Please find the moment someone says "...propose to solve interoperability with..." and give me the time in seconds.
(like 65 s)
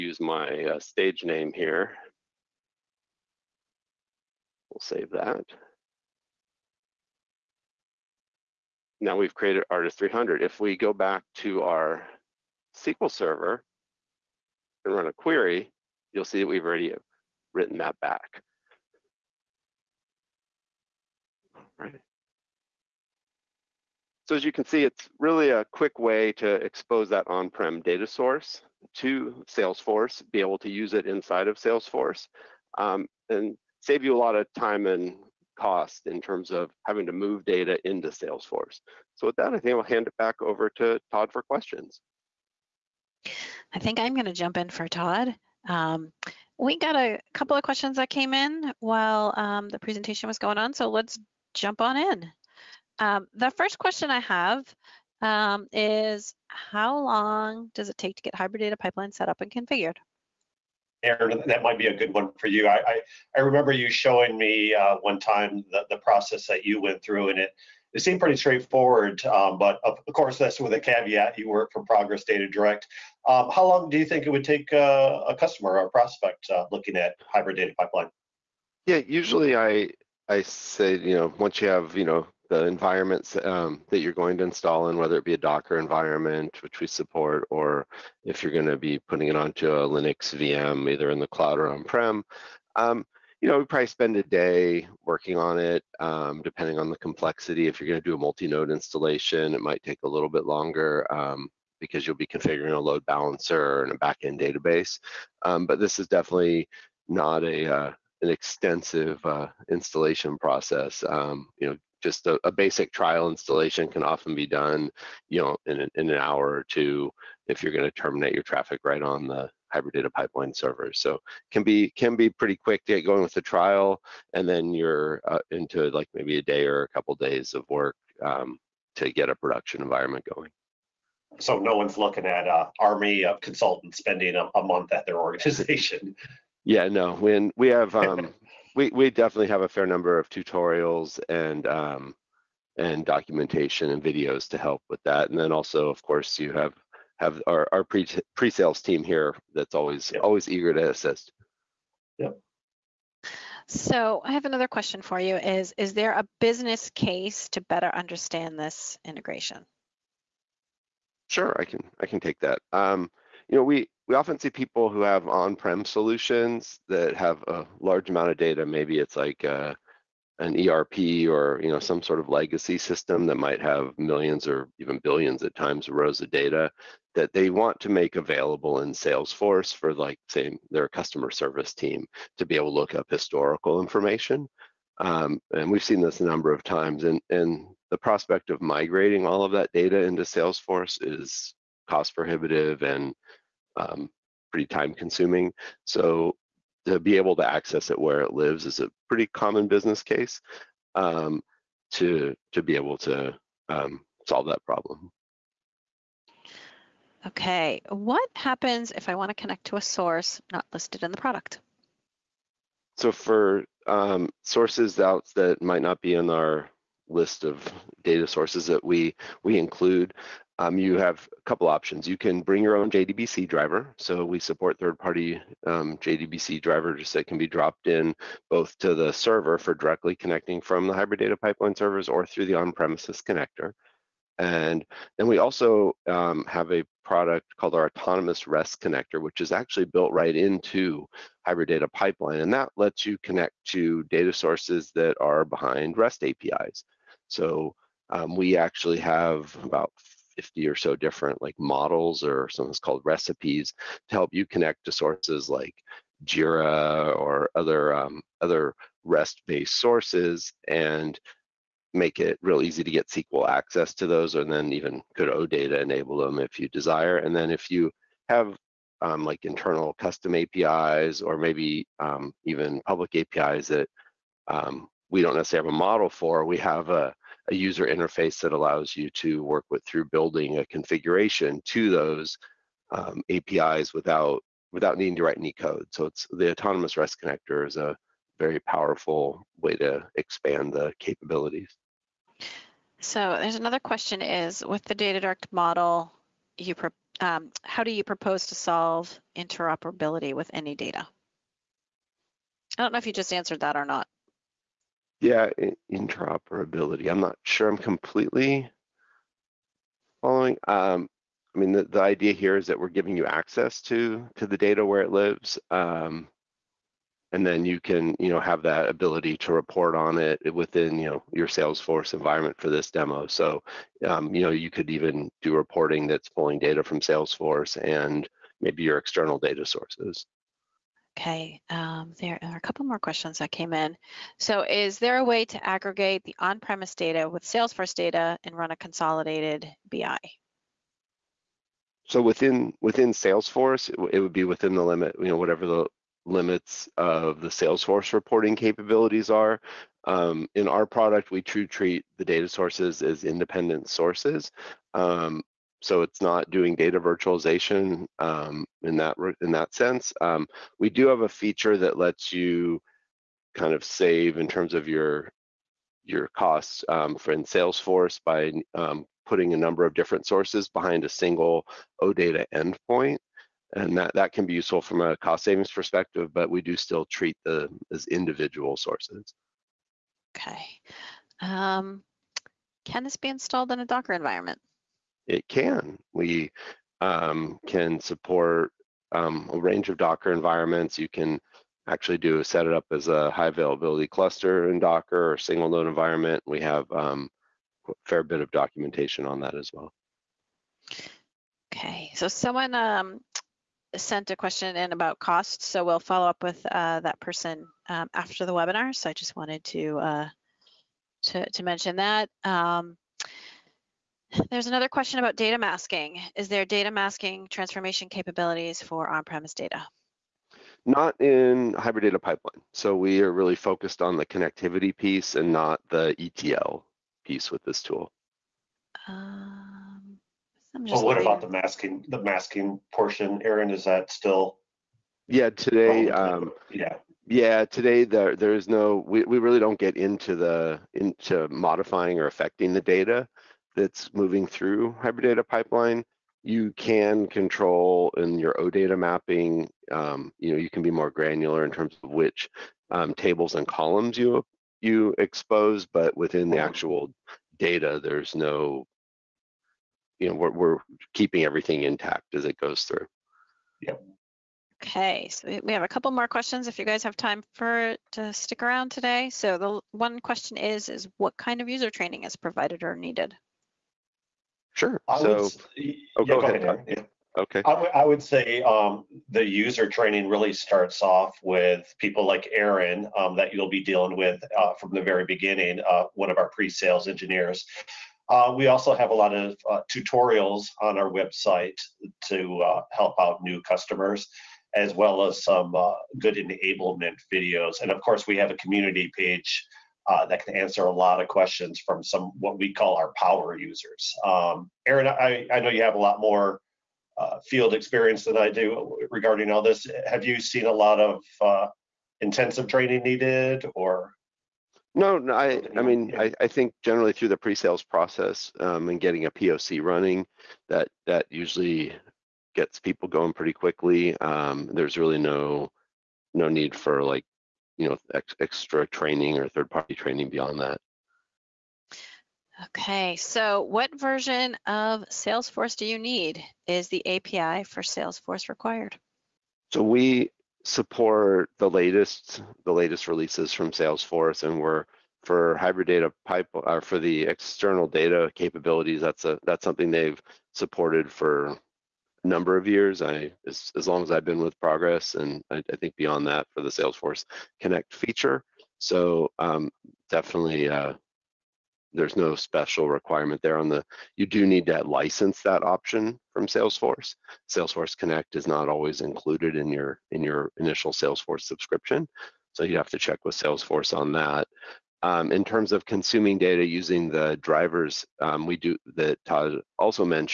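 298 s.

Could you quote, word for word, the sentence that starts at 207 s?
Okay, what happens if I want to connect to a source not listed in the product?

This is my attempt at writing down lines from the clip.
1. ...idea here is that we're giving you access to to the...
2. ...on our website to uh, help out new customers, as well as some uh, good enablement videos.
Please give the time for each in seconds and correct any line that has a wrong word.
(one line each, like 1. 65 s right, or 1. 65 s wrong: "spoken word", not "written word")
1. 312 s right
2. 490 s right.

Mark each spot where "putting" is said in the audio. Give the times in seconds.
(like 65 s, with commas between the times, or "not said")
88 s, 369 s.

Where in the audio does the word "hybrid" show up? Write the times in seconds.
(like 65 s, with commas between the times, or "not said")
58 s, 77 s, 119 s, 230 s, 241 s, 421 s, 445 s, 545 s.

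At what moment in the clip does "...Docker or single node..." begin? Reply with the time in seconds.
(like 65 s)
394 s.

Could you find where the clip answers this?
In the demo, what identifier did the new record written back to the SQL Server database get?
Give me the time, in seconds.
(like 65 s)
9 s.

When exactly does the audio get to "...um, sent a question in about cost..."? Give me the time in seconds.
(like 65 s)
402 s.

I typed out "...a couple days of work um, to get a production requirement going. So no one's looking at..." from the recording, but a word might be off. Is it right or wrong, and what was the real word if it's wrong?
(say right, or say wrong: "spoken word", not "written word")
wrong: "environment", not "requirement".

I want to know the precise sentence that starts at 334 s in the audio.
So is there a way to aggregate the on-premise data with Salesforce data and run a consolidated BI?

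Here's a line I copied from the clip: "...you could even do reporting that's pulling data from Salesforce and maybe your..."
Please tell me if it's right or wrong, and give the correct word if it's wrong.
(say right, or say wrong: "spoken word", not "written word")
right.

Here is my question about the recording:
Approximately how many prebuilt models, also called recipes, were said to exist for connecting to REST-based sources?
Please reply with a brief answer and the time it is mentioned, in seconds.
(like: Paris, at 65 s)
50, at 250 s.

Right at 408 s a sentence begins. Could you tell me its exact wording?
So I just wanted to uh, to, to mention that.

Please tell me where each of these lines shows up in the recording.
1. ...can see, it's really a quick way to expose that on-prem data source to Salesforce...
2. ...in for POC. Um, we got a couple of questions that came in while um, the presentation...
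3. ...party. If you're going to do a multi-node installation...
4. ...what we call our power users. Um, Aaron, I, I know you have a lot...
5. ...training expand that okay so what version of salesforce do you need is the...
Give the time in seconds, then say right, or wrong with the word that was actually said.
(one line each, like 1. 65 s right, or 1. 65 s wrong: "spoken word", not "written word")
1. 24 s right
2. 44 s wrong: "Todd", not "POC"
3. 96 s wrong: "complexity", not "party"
4. 502 s right
5. 529 s wrong: "beyond", not "expand".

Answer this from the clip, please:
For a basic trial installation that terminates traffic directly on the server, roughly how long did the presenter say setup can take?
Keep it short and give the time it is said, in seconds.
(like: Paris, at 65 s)
an hour or two, at 116 s.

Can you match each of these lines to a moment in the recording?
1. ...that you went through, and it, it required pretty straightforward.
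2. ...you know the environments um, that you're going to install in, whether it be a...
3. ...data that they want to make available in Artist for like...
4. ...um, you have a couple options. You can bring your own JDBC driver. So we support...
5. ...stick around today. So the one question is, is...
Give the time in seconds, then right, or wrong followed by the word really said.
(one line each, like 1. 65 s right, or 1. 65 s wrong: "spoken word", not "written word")
1. 66 s wrong: "seemed", not "required"
2. 81 s right
3. 176 s wrong: "Salesforce", not "Artist"
4. 220 s right
5. 468 s right.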